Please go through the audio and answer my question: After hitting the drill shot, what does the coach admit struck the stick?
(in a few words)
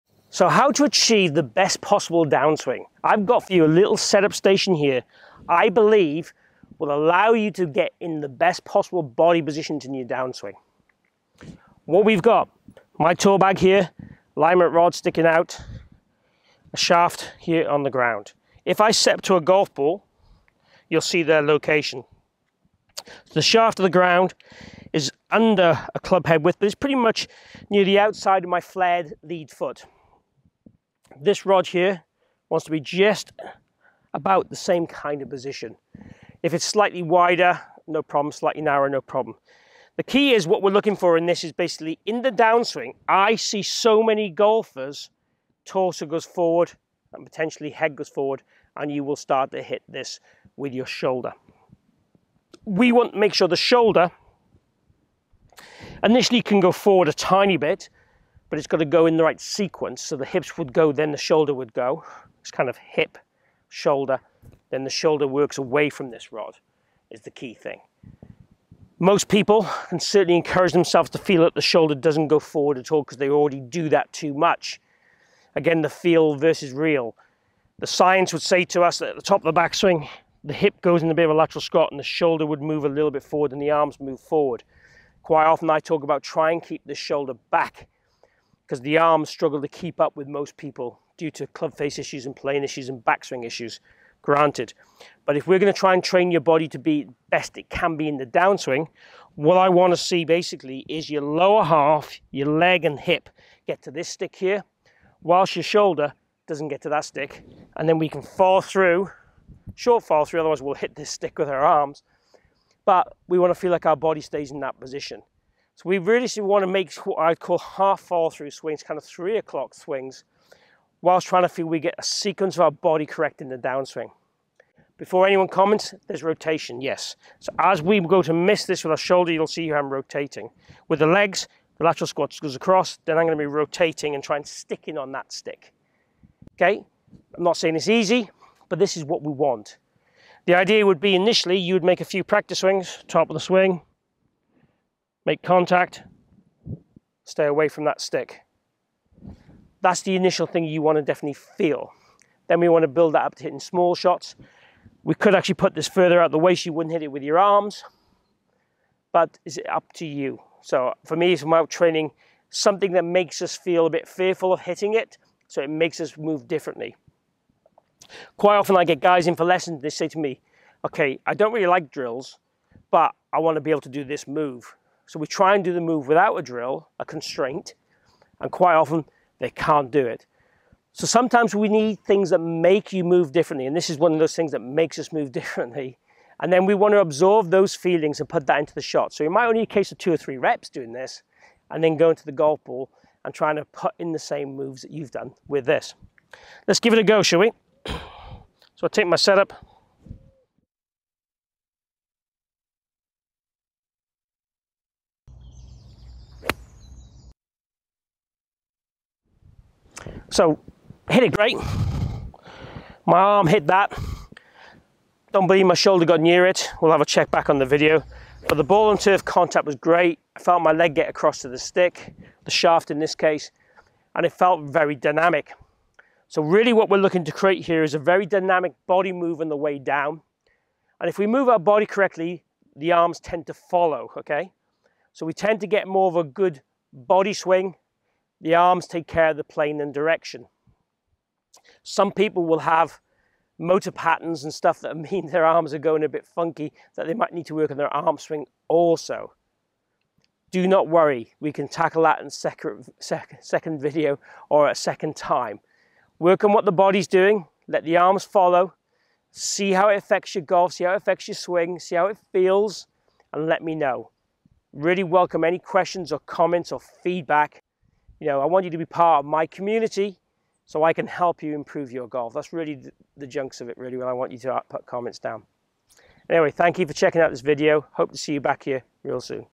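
My arm.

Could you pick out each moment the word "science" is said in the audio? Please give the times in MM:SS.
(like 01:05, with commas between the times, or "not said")
01:17.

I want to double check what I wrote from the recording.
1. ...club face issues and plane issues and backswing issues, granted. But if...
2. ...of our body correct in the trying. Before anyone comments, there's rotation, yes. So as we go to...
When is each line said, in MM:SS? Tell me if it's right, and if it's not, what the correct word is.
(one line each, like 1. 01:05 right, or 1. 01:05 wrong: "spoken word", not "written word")
1. 01:31 right
2. 02:02 wrong: "downswing", not "trying".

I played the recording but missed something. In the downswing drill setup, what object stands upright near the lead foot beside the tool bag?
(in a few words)
Alignment rod.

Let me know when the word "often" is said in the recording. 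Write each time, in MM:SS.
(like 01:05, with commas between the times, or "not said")
01:25, 02:48, 02:58.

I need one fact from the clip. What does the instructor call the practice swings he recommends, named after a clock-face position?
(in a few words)
Three o'clock swings.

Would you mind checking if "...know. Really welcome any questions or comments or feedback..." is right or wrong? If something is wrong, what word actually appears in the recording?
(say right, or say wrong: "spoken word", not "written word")
right.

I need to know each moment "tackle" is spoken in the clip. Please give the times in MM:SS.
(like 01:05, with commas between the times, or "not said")
04:11.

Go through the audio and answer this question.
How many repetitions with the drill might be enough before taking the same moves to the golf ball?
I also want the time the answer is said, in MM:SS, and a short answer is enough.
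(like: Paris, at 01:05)
2 or 3, at 03:09.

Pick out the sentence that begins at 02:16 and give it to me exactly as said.
Okay, I'm not saying it's easy, but this is what we want.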